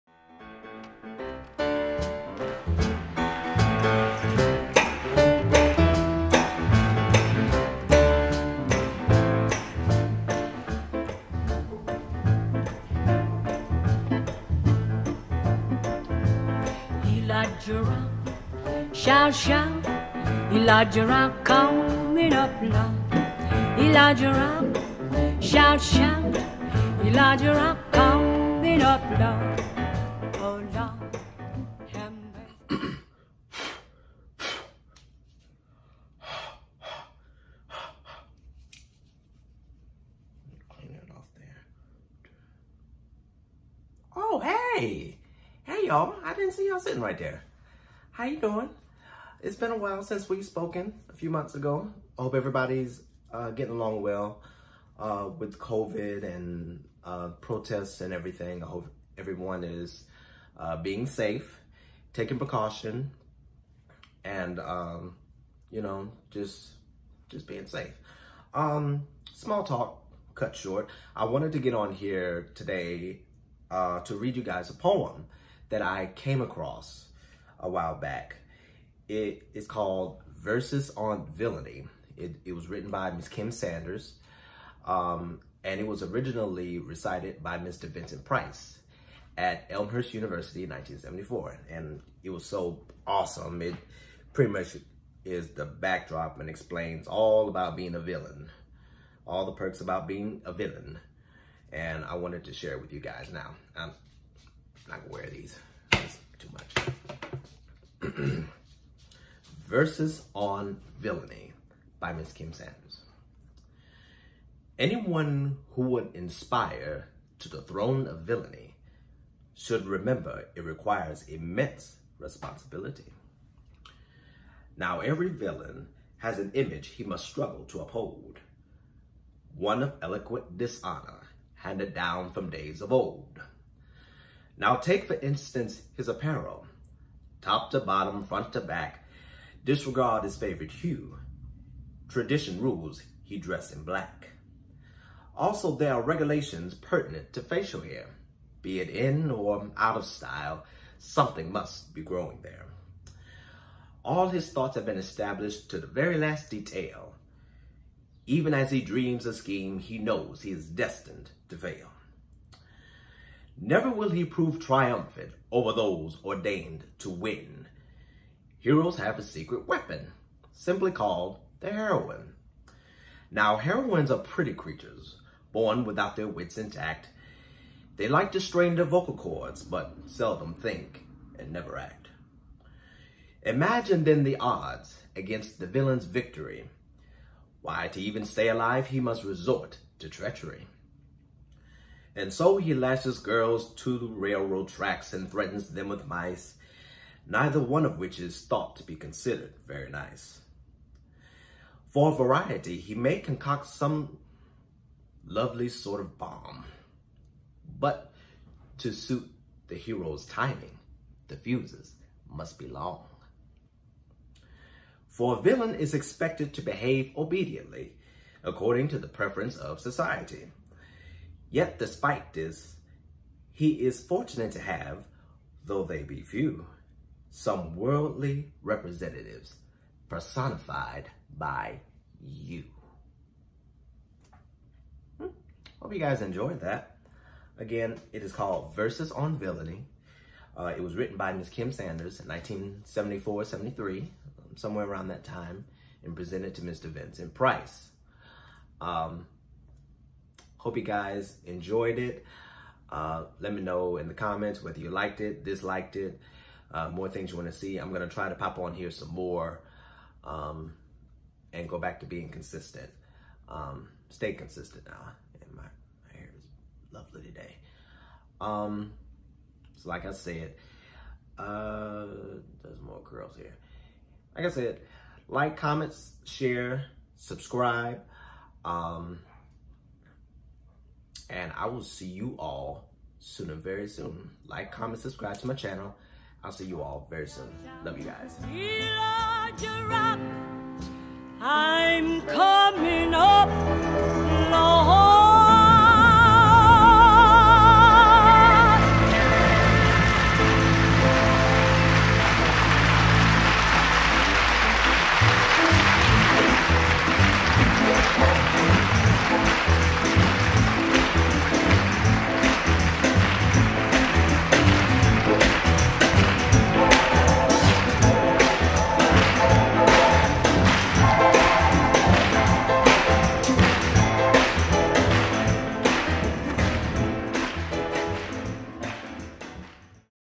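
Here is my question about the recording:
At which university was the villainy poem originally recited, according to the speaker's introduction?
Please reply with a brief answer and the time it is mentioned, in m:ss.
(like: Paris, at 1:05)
Elmhurst University, at 1:29.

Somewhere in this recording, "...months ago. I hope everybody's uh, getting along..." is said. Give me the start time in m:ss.
0:51.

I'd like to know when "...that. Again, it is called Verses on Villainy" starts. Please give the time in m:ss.
3:56.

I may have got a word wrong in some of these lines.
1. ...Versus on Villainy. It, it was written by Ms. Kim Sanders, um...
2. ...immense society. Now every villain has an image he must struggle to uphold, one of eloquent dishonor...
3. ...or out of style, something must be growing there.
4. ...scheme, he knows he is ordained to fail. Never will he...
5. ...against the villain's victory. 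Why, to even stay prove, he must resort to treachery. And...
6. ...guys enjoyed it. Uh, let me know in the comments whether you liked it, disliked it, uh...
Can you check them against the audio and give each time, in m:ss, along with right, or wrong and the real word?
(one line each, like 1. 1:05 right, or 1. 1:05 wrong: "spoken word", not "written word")
1. 1:20 right
2. 2:01 wrong: "responsibility", not "society"
3. 2:29 right
4. 2:39 wrong: "destined", not "ordained"
5. 3:05 wrong: "alive", not "prove"
6. 4:10 right.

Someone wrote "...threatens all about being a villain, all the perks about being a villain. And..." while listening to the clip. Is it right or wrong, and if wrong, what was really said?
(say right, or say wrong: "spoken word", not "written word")
wrong: "explains", not "threatens".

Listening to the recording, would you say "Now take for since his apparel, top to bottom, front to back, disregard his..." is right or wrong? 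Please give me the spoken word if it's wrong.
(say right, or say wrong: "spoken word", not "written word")
wrong: "instance", not "since".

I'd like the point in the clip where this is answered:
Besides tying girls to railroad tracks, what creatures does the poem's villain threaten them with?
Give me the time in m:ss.
3:16.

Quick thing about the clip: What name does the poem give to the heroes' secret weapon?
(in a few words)
The heroine.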